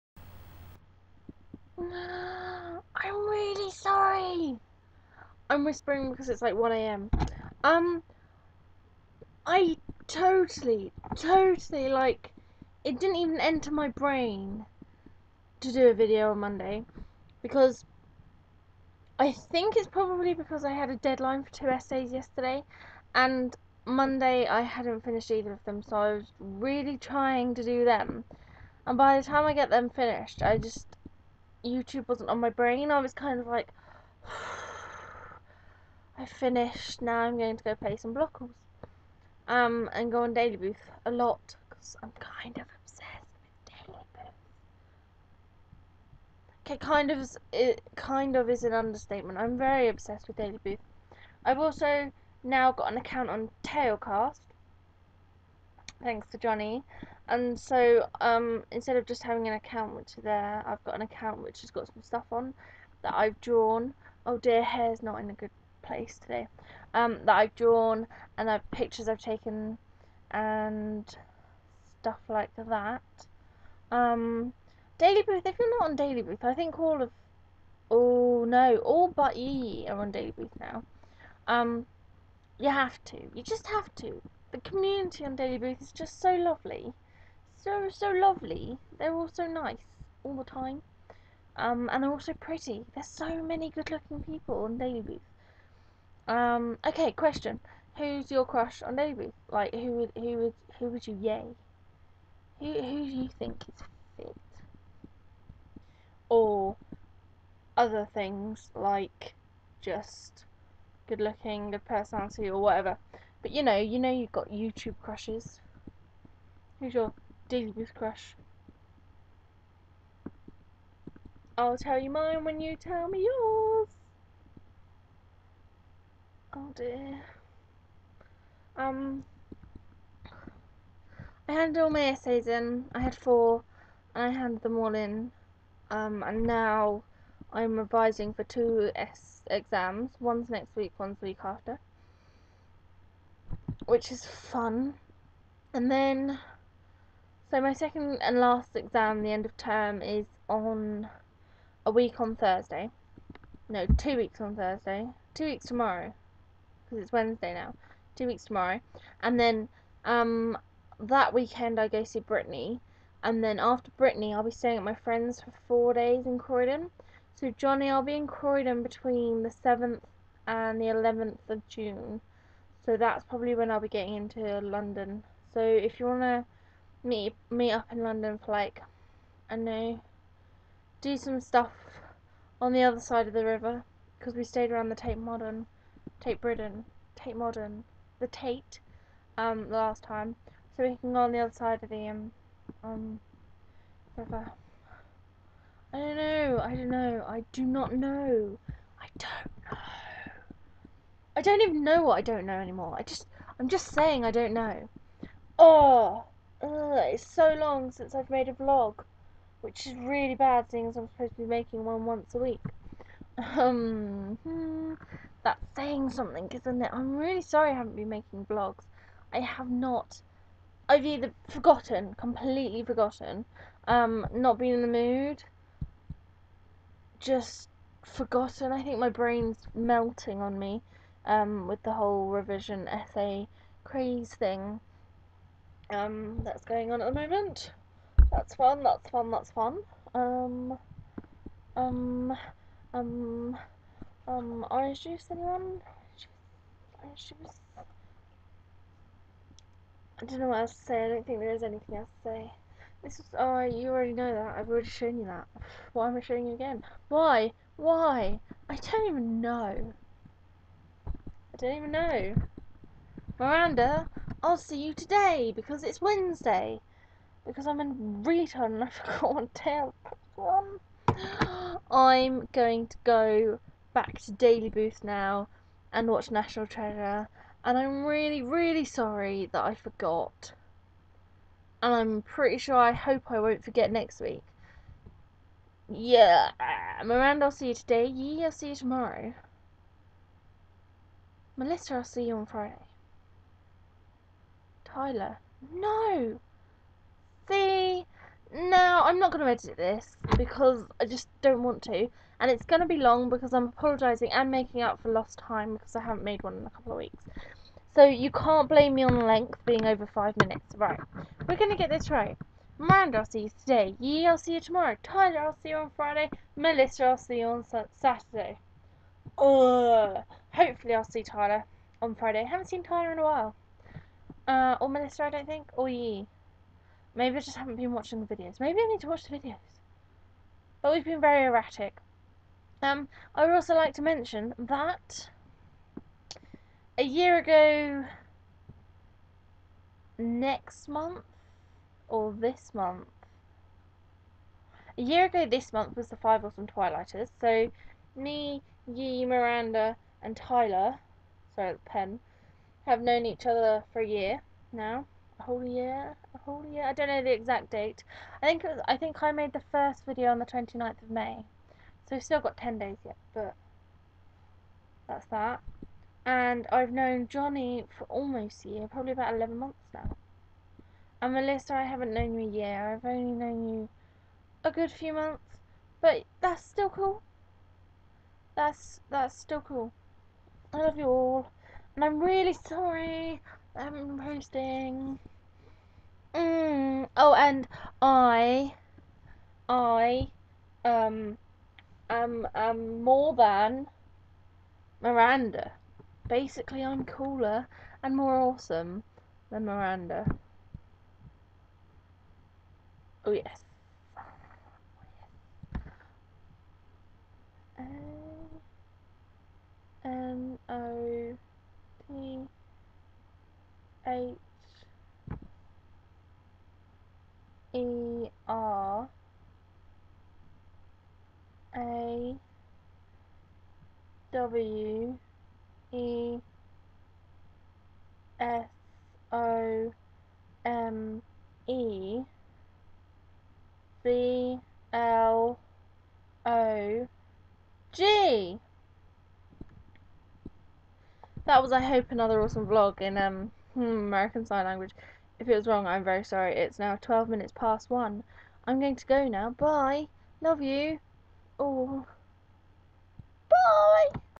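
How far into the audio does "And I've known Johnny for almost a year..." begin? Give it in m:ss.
6:06.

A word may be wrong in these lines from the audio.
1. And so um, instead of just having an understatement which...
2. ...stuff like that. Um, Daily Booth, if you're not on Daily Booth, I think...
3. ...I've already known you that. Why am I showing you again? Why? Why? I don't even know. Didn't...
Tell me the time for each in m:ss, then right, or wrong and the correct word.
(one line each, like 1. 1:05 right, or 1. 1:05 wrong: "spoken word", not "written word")
1. 0:57 wrong: "account", not "understatement"
2. 1:12 right
3. 4:14 wrong: "shown", not "known".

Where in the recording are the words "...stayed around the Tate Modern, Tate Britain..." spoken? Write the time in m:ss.
3:04.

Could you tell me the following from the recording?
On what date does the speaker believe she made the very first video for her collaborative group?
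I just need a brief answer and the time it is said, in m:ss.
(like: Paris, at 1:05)
29th of May, at 6:00.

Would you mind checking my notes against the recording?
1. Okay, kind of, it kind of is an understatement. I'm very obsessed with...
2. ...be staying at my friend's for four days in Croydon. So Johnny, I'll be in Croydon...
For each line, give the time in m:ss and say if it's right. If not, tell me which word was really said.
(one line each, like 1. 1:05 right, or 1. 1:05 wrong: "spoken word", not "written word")
1. 0:46 right
2. 2:44 right.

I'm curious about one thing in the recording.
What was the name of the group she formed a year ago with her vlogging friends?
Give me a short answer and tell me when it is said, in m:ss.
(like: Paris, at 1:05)
five awesome twilighters, at 5:46.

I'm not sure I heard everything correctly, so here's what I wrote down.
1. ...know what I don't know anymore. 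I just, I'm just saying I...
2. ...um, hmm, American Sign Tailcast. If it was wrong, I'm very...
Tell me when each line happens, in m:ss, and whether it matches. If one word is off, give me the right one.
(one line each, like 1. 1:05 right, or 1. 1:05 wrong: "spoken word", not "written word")
1. 3:21 right
2. 7:23 wrong: "Language", not "Tailcast".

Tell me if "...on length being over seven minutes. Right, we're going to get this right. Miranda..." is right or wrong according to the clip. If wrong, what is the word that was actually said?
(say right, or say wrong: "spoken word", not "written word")
wrong: "five", not "seven".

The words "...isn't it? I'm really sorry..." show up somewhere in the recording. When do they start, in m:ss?
3:36.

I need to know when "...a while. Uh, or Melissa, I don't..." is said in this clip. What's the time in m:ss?
5:23.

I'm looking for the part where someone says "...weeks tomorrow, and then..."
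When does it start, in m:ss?
2:38.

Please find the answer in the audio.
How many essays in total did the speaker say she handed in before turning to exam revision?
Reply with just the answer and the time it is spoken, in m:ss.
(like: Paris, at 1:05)
4, at 2:12.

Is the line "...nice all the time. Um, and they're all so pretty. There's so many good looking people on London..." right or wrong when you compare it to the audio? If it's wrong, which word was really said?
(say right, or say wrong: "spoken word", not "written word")
wrong: "Daily", not "London".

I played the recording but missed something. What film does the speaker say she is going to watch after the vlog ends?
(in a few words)
National Treasure.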